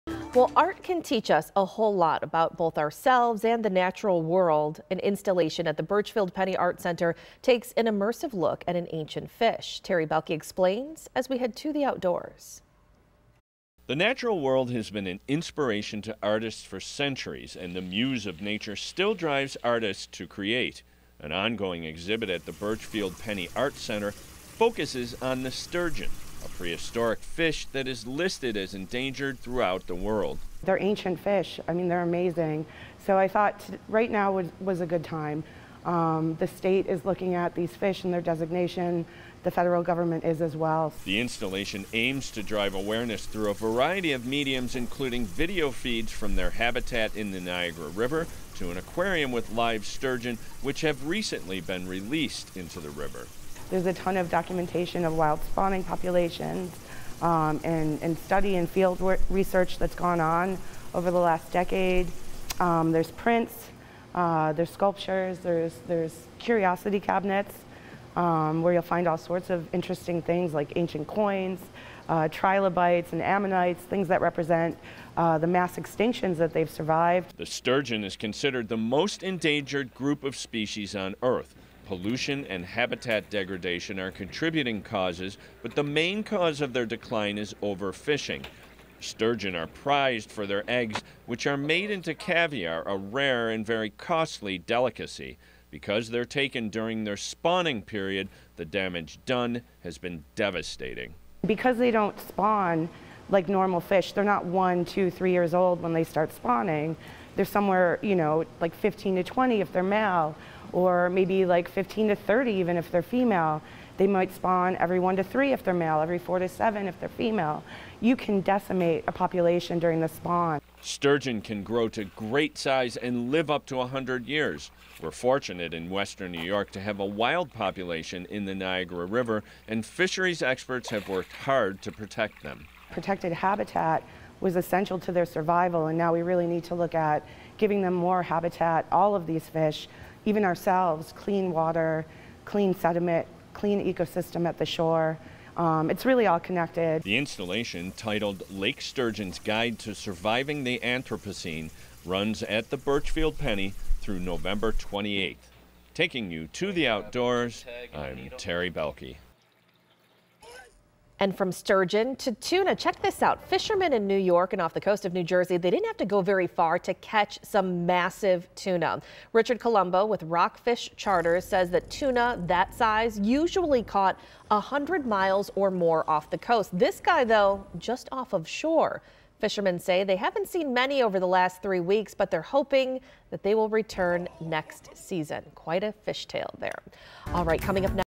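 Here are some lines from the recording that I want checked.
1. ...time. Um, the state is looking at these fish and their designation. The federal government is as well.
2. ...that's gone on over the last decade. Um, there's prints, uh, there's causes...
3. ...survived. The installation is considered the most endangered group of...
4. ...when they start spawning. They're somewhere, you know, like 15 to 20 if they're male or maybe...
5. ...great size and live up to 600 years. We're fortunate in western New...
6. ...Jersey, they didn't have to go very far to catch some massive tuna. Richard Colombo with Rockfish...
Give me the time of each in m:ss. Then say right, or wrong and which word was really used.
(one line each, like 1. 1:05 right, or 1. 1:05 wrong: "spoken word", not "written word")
1. 0:35 right
2. 0:59 wrong: "sculptures", not "causes"
3. 1:16 wrong: "sturgeon", not "installation"
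4. 1:45 right
5. 2:02 wrong: "100", not "600"
6. 2:45 right.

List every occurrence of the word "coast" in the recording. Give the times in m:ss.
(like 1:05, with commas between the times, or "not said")
2:44, 2:56.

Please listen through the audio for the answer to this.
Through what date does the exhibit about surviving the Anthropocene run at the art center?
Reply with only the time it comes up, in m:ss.
2:34.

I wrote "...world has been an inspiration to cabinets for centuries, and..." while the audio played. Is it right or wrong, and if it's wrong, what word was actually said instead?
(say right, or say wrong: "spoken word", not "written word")
wrong: "artists", not "cabinets".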